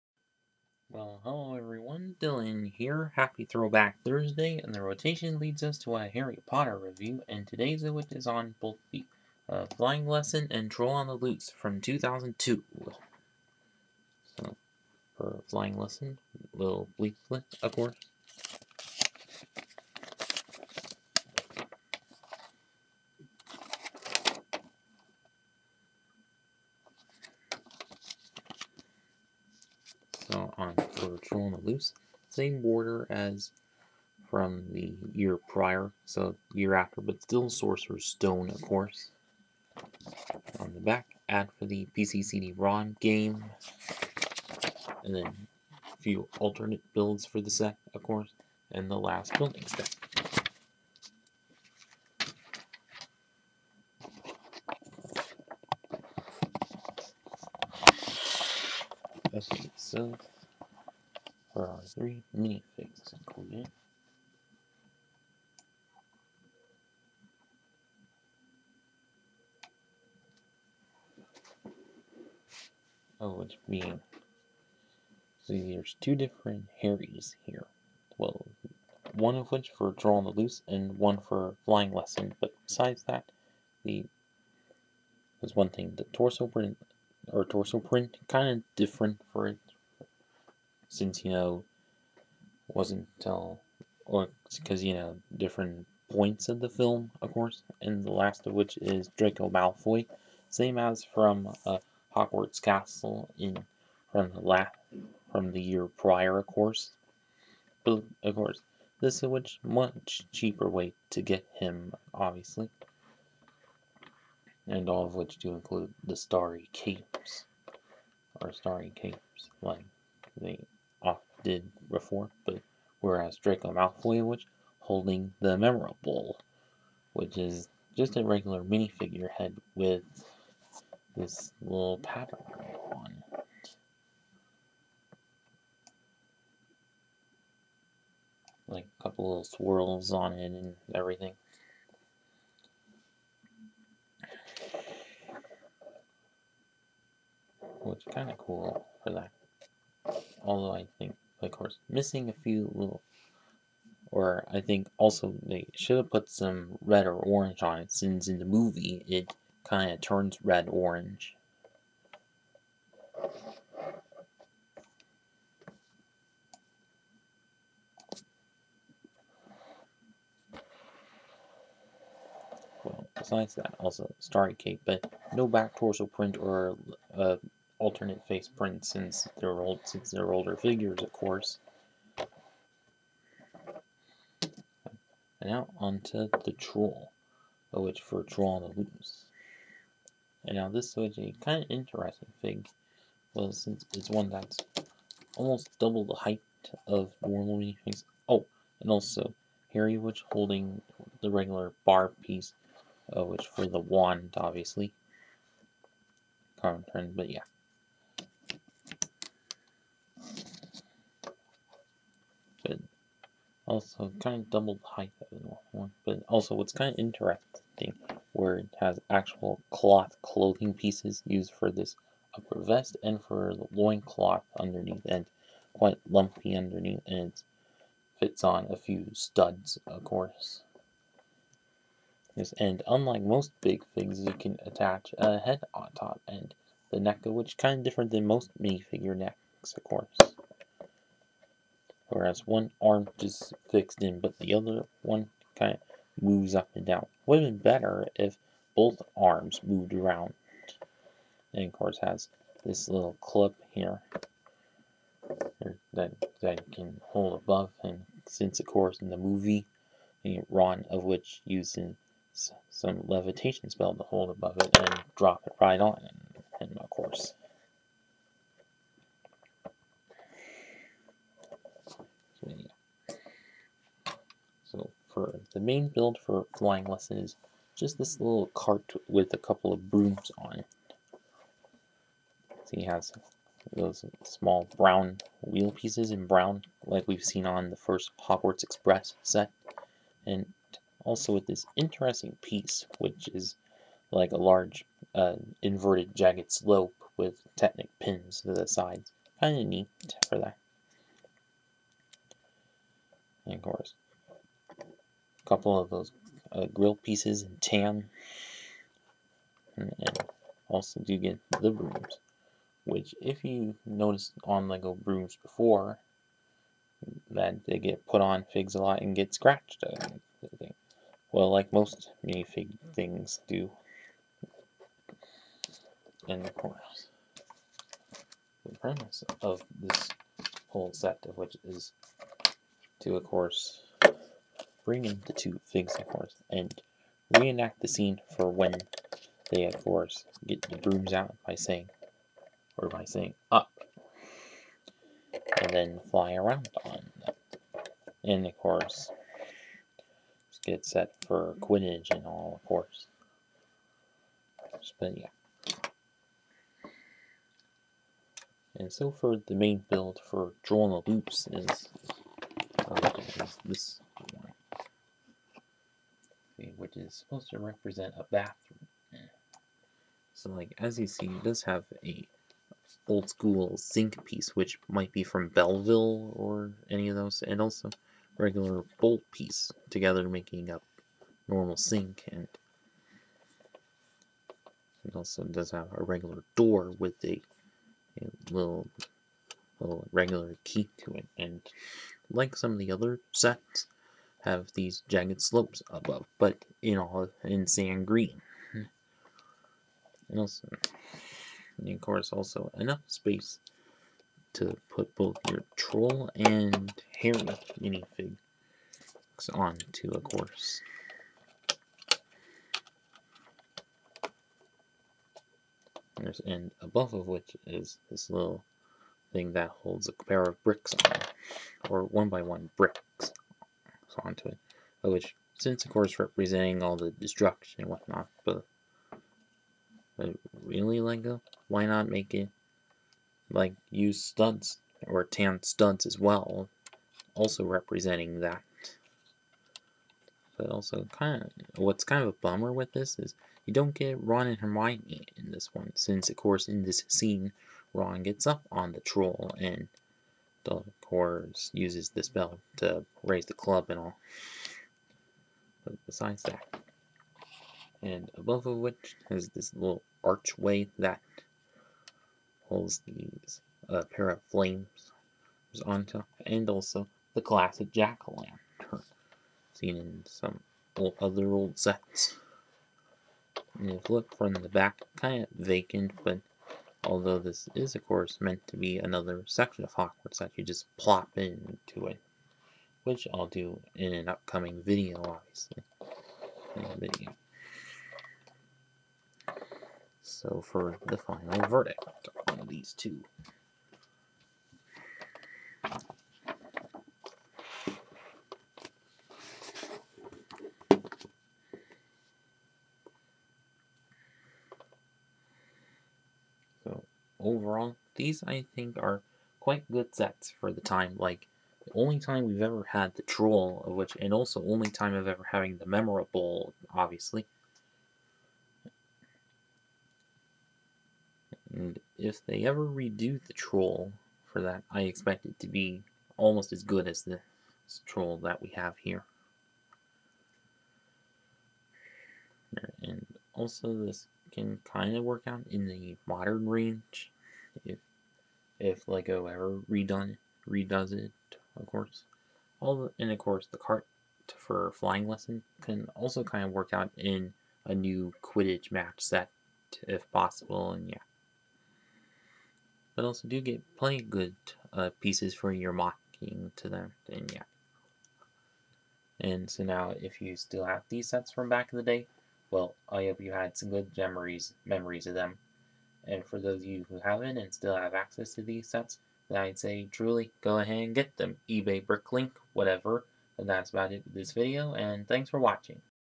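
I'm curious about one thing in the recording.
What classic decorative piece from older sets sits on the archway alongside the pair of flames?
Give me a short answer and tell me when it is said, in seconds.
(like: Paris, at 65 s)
Jack-o'-lantern, at 467 s.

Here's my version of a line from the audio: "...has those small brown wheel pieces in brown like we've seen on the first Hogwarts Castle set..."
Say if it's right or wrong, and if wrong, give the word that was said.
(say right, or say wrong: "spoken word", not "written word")
wrong: "Express", not "Castle".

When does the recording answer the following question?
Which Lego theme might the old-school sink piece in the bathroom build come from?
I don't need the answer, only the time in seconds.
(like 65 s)
375 s.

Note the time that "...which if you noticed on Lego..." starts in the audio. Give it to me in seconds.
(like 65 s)
312 s.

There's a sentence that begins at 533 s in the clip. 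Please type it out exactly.
And also this can kind of work out in the modern range if if Lego ever redone redoes it, of course.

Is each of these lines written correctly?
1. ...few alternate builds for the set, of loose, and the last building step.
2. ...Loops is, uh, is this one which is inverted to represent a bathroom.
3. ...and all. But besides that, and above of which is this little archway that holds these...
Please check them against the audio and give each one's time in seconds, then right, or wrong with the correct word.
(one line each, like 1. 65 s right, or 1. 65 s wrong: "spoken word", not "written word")
1. 46 s wrong: "course", not "loose"
2. 361 s wrong: "supposed", not "inverted"
3. 453 s right.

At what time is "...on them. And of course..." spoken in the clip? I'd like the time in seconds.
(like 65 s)
346 s.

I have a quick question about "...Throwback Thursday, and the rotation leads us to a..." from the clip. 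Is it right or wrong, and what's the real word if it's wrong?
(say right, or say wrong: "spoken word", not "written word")
right.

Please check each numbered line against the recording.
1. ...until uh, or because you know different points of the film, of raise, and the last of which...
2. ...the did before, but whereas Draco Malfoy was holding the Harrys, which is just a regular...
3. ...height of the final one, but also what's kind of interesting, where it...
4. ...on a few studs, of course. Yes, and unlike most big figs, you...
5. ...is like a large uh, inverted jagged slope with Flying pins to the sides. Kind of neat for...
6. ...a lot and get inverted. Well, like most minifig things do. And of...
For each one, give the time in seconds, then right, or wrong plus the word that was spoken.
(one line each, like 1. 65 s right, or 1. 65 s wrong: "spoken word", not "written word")
1. 93 s wrong: "course", not "raise"
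2. 120 s wrong: "Remembrall", not "Harrys"
3. 214 s wrong: "normal", not "final"
4. 228 s right
5. 293 s wrong: "Technic", not "Flying"
6. 318 s wrong: "scratched", not "inverted".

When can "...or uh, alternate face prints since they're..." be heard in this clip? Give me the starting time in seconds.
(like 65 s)
176 s.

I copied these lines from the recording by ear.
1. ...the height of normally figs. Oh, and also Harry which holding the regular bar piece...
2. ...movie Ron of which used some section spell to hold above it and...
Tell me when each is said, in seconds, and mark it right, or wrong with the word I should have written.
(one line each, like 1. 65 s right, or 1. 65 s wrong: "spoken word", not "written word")
1. 196 s right
2. 259 s wrong: "levitation", not "section".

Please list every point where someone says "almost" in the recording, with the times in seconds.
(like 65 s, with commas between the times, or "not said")
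195 s, 526 s.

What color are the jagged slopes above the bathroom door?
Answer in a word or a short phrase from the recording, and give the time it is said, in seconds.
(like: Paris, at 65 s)
Sand green, at 397 s.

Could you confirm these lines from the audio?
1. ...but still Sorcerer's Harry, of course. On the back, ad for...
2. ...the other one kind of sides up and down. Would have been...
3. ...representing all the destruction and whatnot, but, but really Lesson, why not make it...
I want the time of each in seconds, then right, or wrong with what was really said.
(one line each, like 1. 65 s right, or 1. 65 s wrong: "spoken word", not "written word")
1. 37 s wrong: "Stone", not "Harry"
2. 244 s wrong: "moves", not "sides"
3. 426 s wrong: "Lego", not "Lesson".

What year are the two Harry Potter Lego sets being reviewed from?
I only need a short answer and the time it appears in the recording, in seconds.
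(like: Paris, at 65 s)
2002, at 11 s.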